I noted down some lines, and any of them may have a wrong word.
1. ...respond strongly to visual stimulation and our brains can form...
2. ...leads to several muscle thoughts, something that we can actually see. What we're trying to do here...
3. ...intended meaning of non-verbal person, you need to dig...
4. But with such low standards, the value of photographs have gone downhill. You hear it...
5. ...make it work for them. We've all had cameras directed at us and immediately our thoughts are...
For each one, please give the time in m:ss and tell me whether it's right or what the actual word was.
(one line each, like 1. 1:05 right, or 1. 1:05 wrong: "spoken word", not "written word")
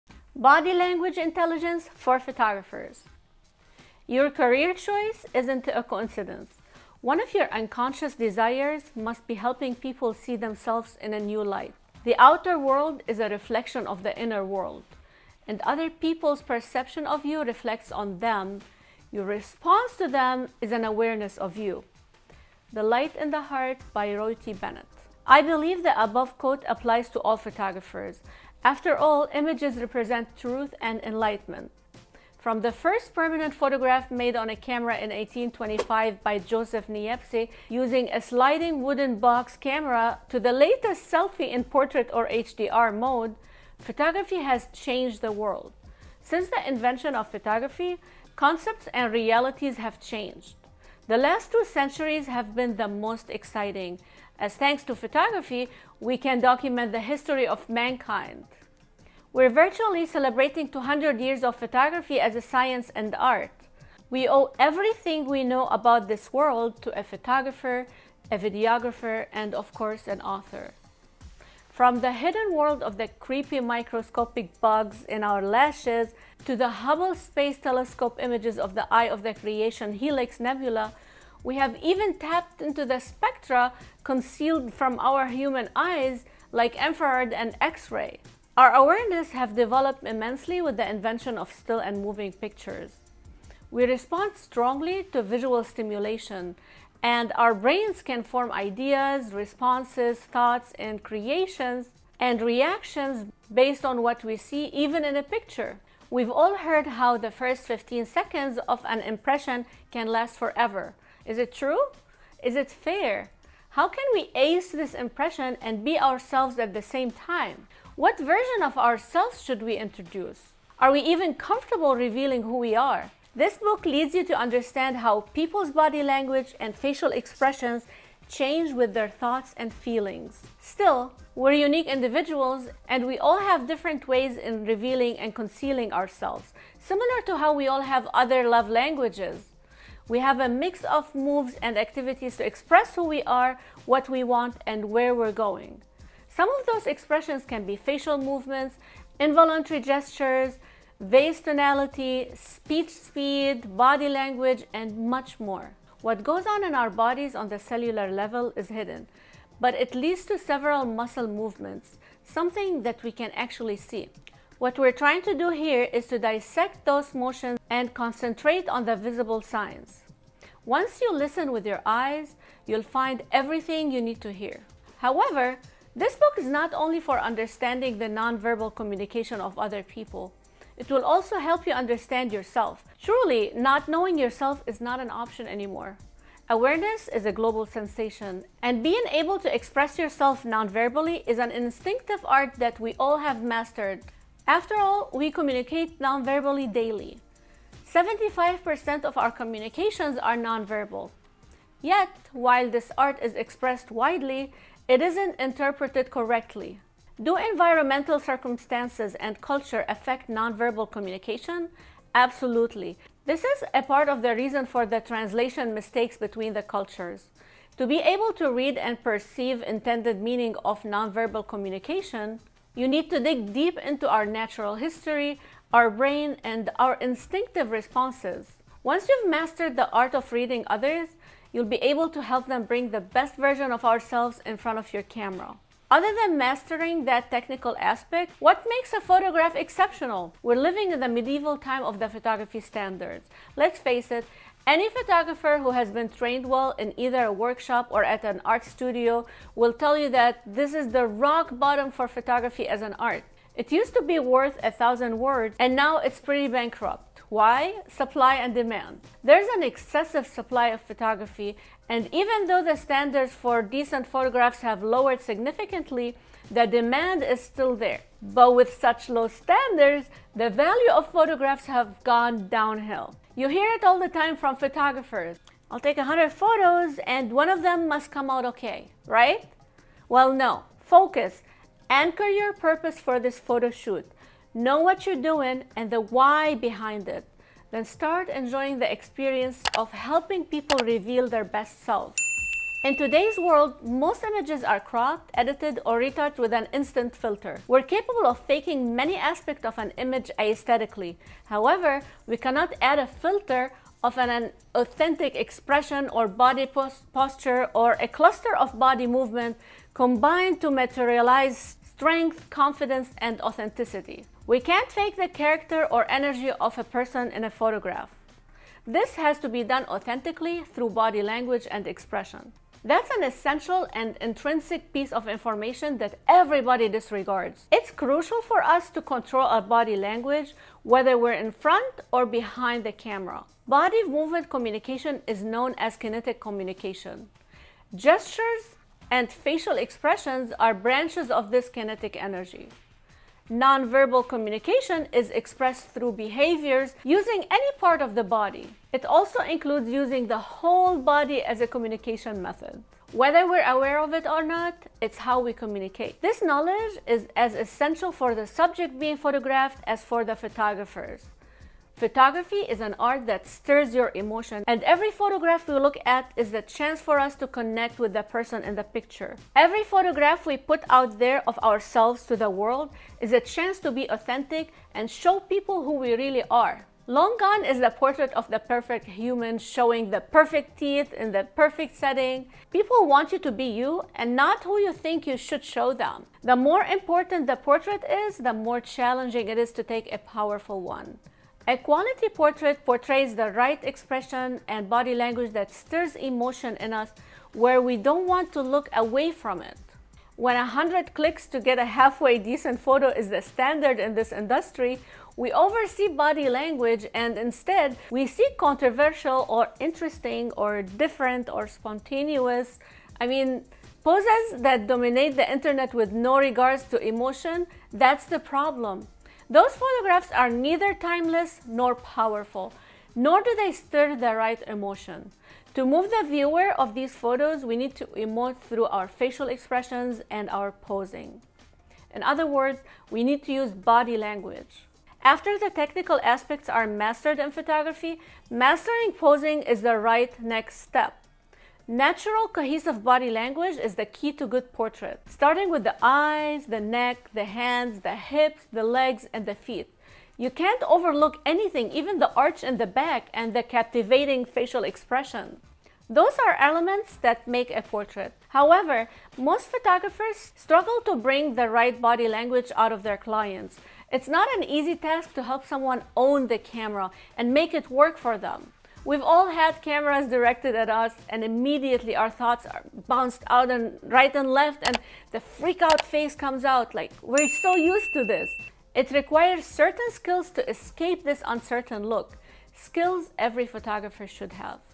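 1. 1:33 right
2. 2:39 wrong: "movements", not "thoughts"
3. 3:39 wrong: "communication", not "person"
4. 4:28 right
5. 7:47 right.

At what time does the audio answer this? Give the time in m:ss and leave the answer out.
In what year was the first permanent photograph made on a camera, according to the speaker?
0:35.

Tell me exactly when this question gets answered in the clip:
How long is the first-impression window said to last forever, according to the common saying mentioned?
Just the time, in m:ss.
1:47.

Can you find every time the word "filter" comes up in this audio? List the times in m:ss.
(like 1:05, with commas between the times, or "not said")
4:57, 5:03.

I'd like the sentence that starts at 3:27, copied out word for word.
Do environmental circumstances and culture affect non-verbal communication?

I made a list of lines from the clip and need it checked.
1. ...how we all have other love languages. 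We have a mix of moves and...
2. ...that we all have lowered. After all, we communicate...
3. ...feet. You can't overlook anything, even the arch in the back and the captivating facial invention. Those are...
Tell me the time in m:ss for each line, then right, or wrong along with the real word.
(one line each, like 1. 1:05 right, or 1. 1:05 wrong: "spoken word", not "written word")
1. 2:17 right
2. 3:12 wrong: "mastered", not "lowered"
3. 7:29 wrong: "expression", not "invention".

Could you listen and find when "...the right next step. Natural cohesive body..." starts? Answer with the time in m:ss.
7:19.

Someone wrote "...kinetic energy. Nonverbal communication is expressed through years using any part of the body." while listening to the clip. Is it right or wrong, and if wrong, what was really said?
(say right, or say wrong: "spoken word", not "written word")
wrong: "behaviors", not "years".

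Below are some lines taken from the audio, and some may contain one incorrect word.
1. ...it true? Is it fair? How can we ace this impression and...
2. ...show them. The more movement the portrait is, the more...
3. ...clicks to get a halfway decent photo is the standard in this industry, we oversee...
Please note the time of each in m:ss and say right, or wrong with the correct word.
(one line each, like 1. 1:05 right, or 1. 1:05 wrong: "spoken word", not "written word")
1. 1:51 right
2. 6:25 wrong: "important", not "movement"
3. 6:41 right.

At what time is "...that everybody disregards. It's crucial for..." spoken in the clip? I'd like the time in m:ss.
5:25.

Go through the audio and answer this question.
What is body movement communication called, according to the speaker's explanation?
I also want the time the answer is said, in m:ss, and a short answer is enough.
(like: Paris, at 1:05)
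kinetic communication, at 5:35.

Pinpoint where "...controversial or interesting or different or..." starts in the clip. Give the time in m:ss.
6:48.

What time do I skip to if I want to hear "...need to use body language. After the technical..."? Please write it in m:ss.
7:13.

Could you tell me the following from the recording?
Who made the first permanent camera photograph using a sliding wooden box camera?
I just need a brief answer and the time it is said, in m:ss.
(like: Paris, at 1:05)
Joseph Niepce, at 0:36.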